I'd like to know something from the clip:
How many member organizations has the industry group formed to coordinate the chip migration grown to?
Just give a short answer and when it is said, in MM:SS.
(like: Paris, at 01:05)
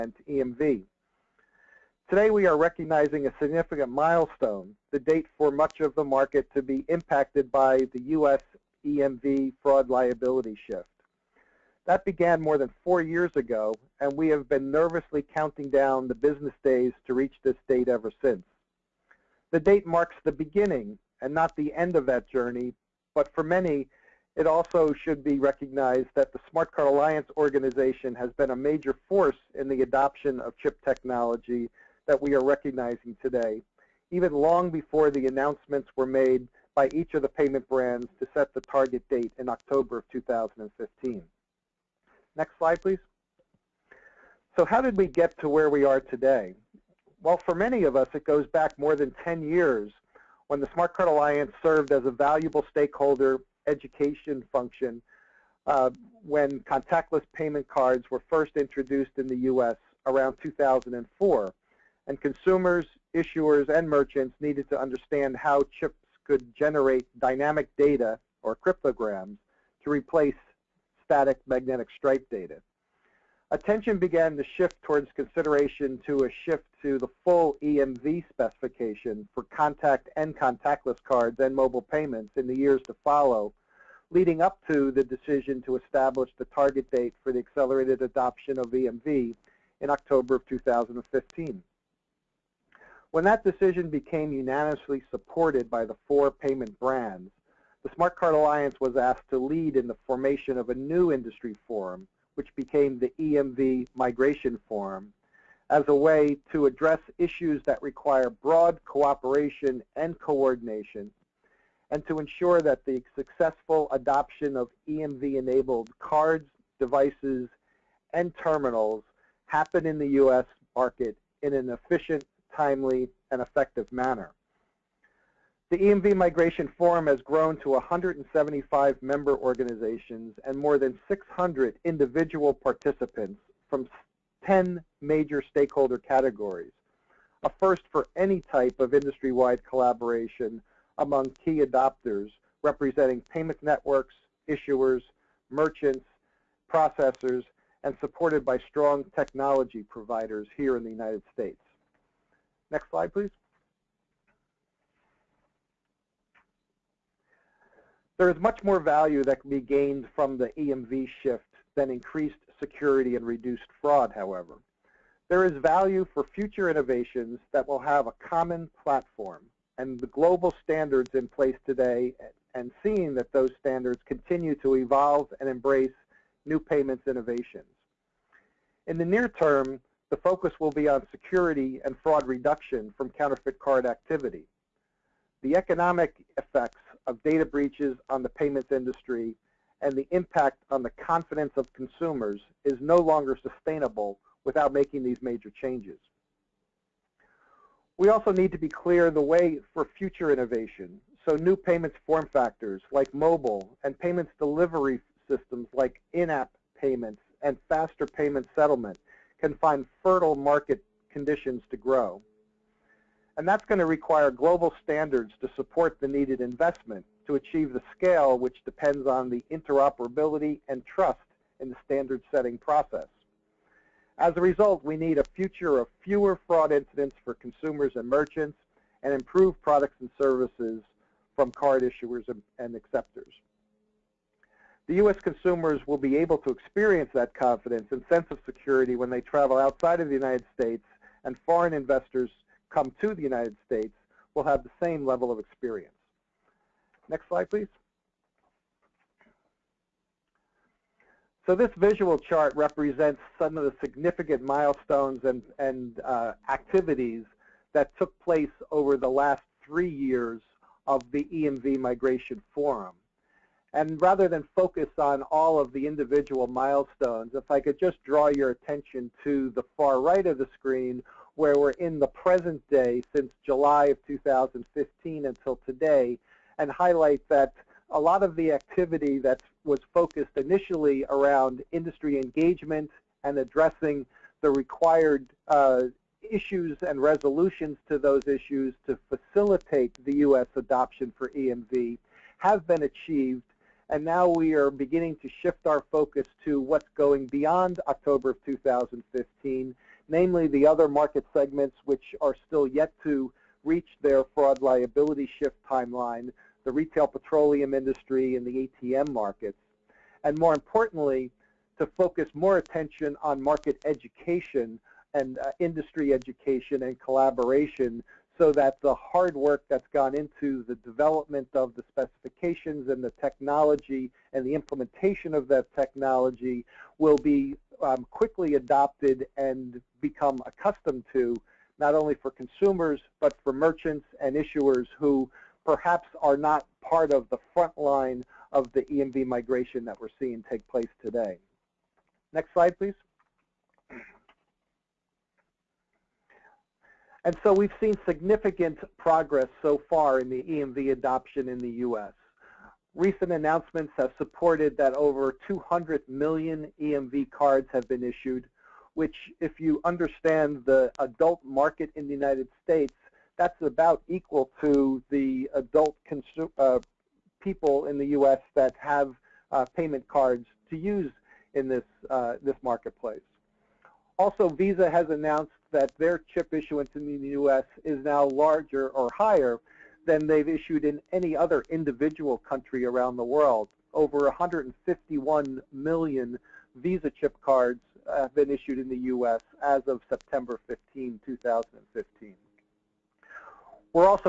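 175, at 02:07.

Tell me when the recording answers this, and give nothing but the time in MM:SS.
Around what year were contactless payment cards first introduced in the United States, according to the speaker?
01:00.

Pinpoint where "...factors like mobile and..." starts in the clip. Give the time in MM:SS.
03:22.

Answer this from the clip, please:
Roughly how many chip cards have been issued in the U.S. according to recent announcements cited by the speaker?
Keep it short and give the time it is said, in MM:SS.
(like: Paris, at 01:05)
over 200 million, at 05:54.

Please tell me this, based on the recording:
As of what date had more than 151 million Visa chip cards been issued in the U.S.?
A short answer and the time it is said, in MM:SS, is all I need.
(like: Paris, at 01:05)
September 15, 2015, at 06:30.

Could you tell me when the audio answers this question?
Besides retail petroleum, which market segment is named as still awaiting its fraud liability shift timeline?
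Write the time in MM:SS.
05:08.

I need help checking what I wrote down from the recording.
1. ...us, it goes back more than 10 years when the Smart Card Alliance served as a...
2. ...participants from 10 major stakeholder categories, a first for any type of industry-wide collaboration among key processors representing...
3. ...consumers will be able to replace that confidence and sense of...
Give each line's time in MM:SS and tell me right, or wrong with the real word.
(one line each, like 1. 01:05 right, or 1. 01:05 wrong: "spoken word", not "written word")
1. 00:47 right
2. 02:12 wrong: "adopters", not "processors"
3. 03:55 wrong: "experience", not "replace".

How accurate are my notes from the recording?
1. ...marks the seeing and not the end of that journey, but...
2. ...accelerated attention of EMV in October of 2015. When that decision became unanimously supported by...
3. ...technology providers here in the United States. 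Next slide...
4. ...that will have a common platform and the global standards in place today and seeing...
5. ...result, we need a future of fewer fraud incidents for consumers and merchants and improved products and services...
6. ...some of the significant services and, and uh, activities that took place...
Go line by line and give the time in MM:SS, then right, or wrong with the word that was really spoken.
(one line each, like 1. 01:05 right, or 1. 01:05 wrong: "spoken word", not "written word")
1. 00:19 wrong: "beginning", not "seeing"
2. 01:27 wrong: "adoption", not "attention"
3. 02:29 right
4. 02:47 right
5. 03:44 right
6. 04:13 wrong: "milestones", not "services".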